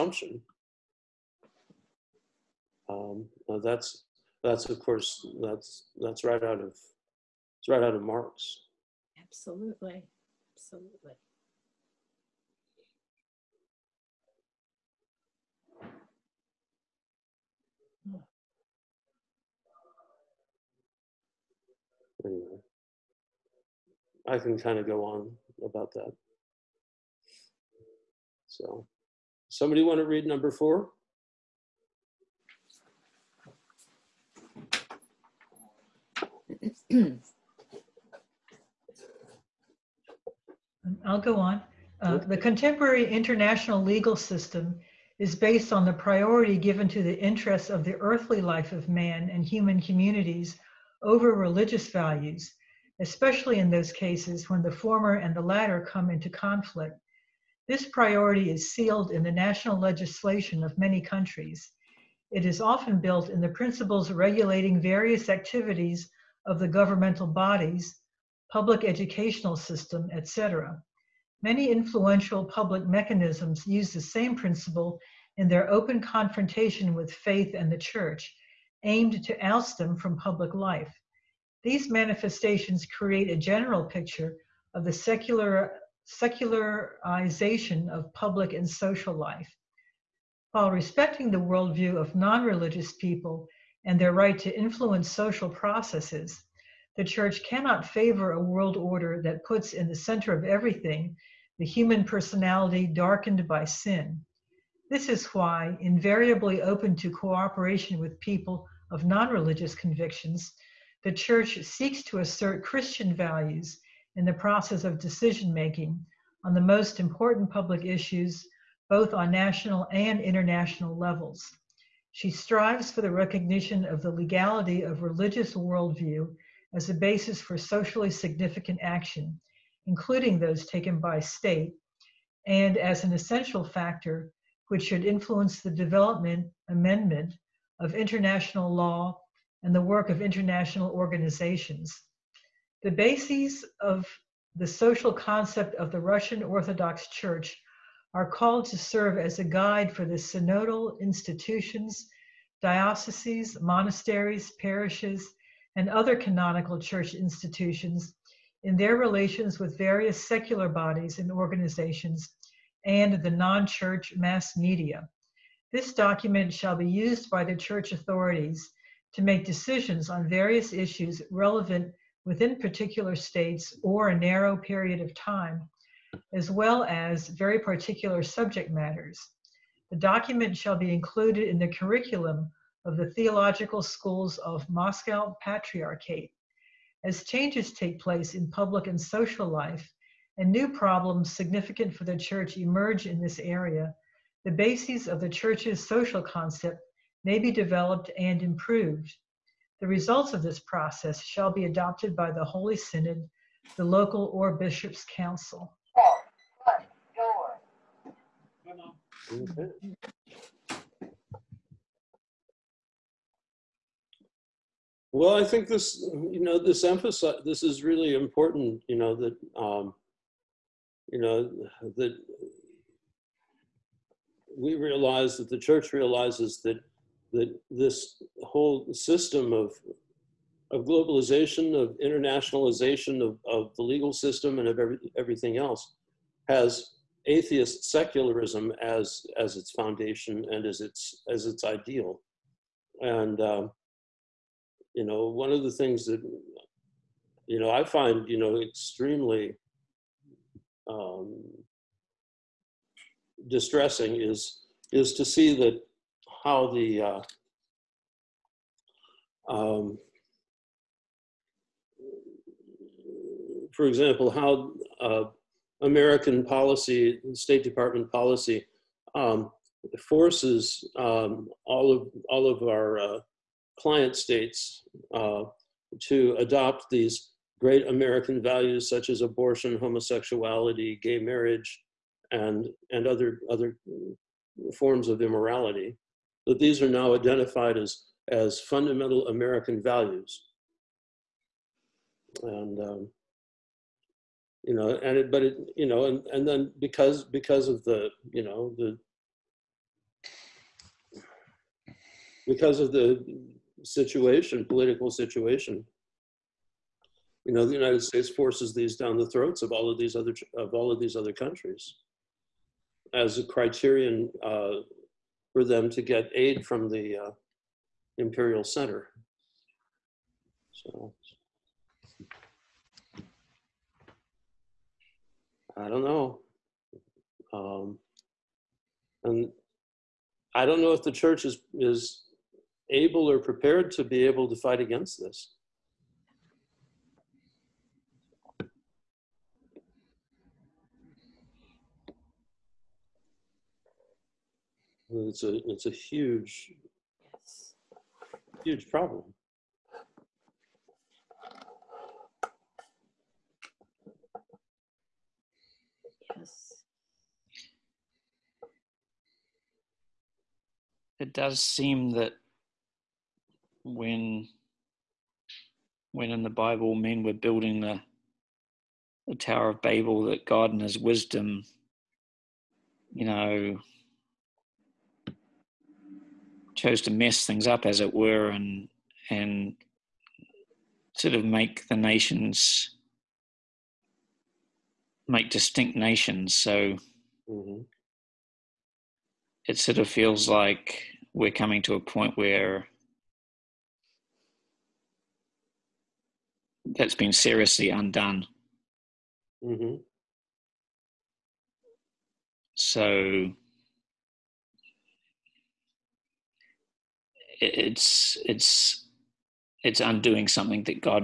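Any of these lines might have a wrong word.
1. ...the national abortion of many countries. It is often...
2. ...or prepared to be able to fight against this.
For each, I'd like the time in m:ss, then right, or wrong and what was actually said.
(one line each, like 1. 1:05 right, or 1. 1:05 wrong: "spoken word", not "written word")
1. 0:59 wrong: "legislation", not "abortion"
2. 5:33 right.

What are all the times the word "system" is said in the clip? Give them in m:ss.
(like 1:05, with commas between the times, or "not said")
0:44, 1:09, 3:48, 3:54.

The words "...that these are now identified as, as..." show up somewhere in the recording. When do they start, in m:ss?
4:46.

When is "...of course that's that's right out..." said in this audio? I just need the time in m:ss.
0:04.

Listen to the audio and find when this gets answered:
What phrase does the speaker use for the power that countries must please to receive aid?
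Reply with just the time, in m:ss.
5:18.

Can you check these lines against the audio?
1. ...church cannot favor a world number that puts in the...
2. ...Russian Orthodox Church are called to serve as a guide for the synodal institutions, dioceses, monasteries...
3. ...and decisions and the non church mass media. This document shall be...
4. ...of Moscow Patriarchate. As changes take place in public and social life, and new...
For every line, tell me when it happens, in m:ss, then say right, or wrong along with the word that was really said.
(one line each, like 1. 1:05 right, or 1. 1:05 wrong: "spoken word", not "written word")
1. 1:37 wrong: "order", not "number"
2. 2:25 right
3. 2:41 wrong: "organizations", not "decisions"
4. 3:04 right.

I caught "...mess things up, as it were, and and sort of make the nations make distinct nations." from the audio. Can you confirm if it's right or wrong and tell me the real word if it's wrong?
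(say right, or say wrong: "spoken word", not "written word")
right.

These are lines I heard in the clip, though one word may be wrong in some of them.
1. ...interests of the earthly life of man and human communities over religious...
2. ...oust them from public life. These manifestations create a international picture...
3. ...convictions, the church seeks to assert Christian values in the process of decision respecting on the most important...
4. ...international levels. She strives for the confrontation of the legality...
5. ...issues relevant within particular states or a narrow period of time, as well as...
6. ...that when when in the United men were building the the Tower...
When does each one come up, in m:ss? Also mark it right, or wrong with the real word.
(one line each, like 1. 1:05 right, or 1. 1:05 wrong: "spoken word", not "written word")
1. 0:47 right
2. 1:19 wrong: "general", not "international"
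3. 1:49 wrong: "making", not "respecting"
4. 2:00 wrong: "recognition", not "confrontation"
5. 2:50 right
6. 6:02 wrong: "Bible", not "United".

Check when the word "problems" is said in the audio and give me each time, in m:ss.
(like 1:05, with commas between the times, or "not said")
3:10, 5:48.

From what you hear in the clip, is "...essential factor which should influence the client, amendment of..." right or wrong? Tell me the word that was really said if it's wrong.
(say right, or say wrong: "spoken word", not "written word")
wrong: "development", not "client".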